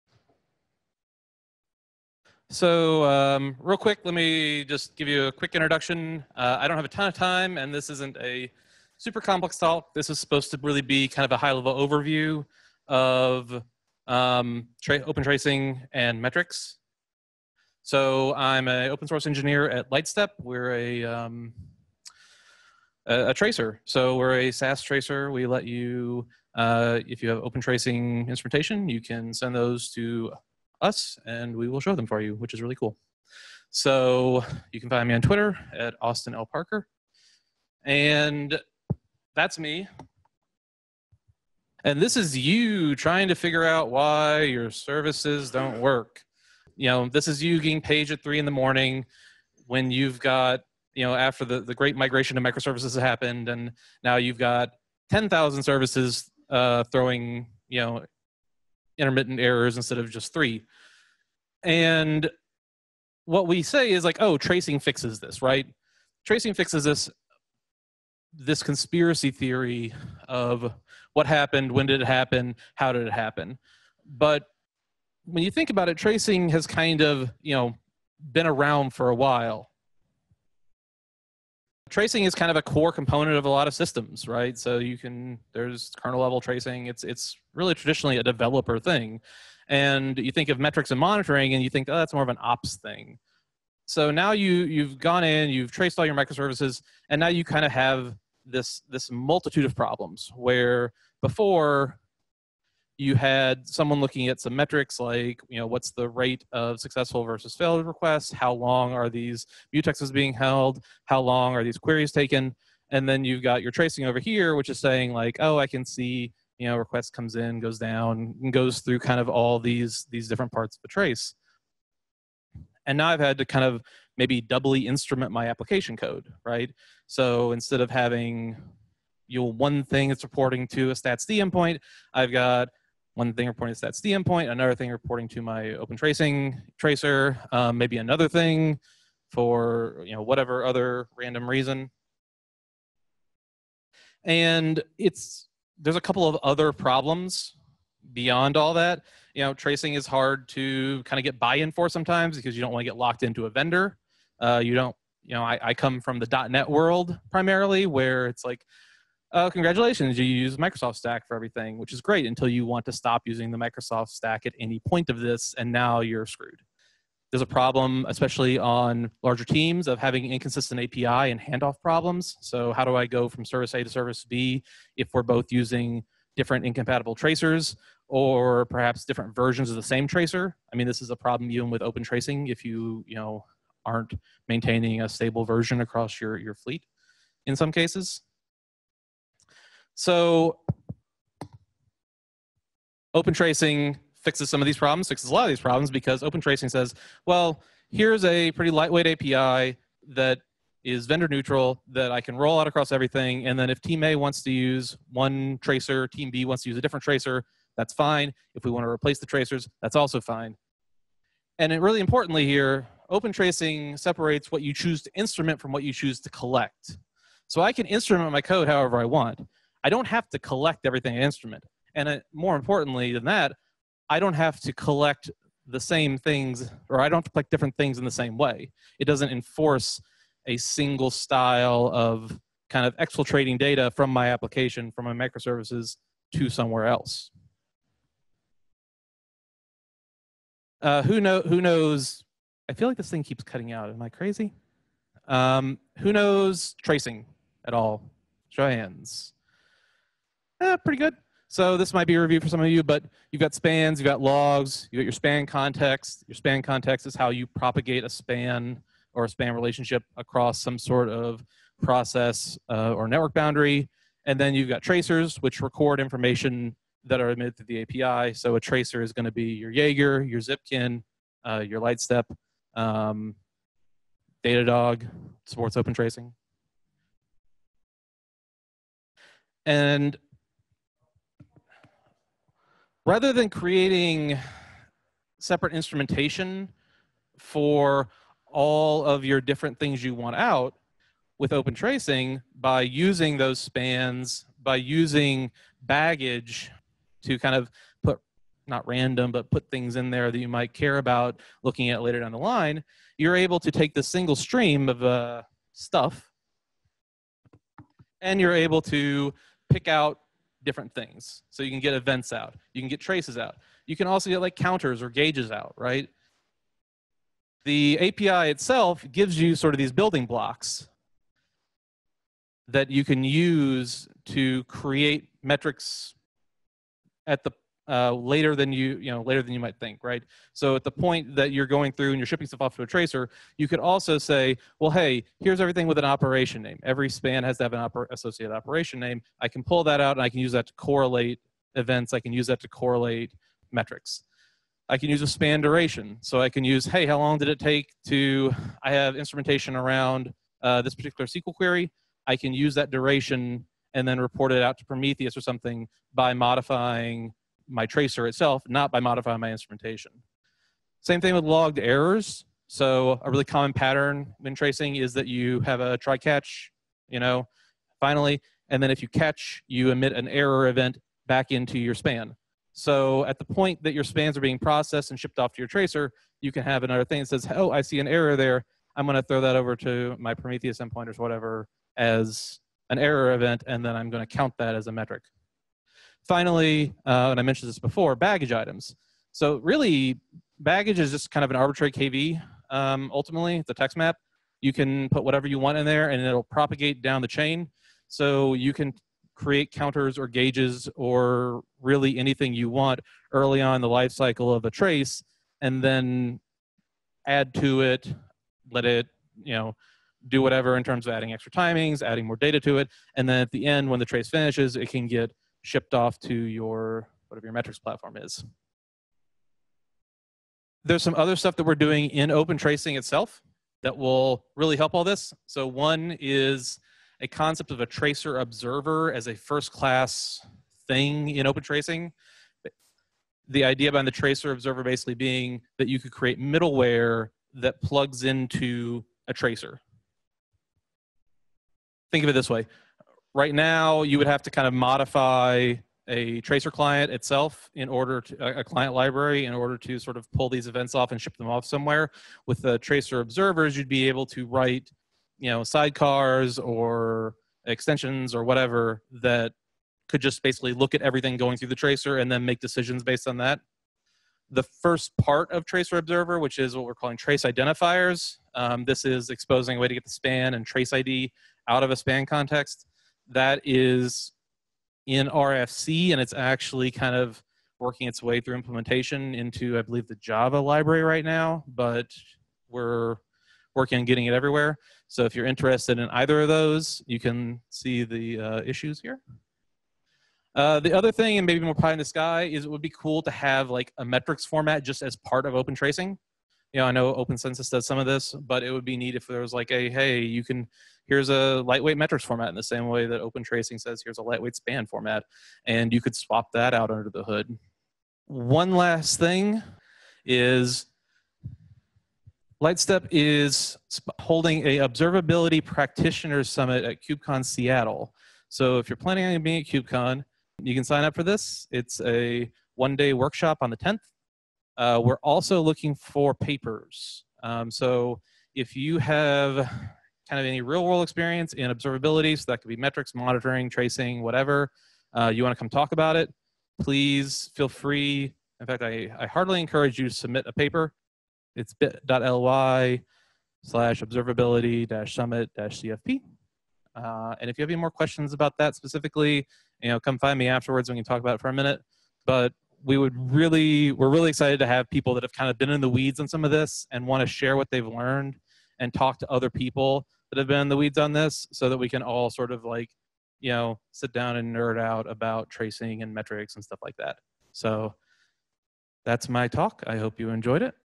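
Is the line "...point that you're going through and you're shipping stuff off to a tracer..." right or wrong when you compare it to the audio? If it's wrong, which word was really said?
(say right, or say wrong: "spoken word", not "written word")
right.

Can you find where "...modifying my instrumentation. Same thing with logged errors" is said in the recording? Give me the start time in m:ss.
5:58.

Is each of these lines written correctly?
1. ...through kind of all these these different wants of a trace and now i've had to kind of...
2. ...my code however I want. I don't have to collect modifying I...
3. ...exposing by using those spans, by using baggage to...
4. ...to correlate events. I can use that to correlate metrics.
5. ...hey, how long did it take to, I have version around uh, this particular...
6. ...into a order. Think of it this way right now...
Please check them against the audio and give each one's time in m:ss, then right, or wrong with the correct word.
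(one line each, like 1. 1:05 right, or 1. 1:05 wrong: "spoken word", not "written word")
1. 1:58 wrong: "parts", not "wants"
2. 3:38 wrong: "everything", not "modifying"
3. 4:51 wrong: "tracing", not "exposing"
4. 5:40 right
5. 5:46 wrong: "instrumentation", not "version"
6. 7:18 wrong: "tracer", not "order".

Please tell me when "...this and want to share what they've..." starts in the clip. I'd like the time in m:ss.
9:16.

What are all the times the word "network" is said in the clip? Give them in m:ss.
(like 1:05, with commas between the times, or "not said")
4:23.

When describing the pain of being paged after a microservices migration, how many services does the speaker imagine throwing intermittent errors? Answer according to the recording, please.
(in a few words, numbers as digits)
10,000.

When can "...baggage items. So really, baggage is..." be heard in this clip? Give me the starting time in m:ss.
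6:28.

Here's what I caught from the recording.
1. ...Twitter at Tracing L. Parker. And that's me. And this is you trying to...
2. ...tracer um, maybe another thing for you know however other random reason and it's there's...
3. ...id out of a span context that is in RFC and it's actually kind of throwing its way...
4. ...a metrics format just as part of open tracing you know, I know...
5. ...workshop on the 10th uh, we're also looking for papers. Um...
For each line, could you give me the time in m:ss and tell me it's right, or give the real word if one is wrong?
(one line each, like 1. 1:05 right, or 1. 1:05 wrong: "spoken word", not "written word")
1. 0:35 wrong: "Austin", not "Tracing"
2. 2:16 wrong: "whatever", not "however"
3. 7:50 wrong: "working", not "throwing"
4. 8:13 right
5. 8:43 right.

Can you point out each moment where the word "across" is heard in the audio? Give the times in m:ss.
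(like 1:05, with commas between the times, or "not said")
3:05, 3:22, 4:20.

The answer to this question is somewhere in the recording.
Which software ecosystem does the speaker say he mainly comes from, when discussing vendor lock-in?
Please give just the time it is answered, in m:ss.
2:36.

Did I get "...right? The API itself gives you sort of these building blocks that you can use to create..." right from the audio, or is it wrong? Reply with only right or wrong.
right.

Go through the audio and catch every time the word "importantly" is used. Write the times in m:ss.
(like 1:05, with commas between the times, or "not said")
3:31, 3:42.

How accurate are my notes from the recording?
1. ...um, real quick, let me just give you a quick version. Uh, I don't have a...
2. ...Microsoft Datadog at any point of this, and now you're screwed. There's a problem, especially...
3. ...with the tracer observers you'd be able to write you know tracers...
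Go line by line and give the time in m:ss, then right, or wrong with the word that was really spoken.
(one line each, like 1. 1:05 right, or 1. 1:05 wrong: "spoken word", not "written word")
1. 0:03 wrong: "introduction", not "version"
2. 2:43 wrong: "Stack", not "Datadog"
3. 7:32 wrong: "sidecars", not "tracers".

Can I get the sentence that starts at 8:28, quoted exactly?
One last thing is Lightstep is holding a observability practitioners summit at KubeCon Seattle.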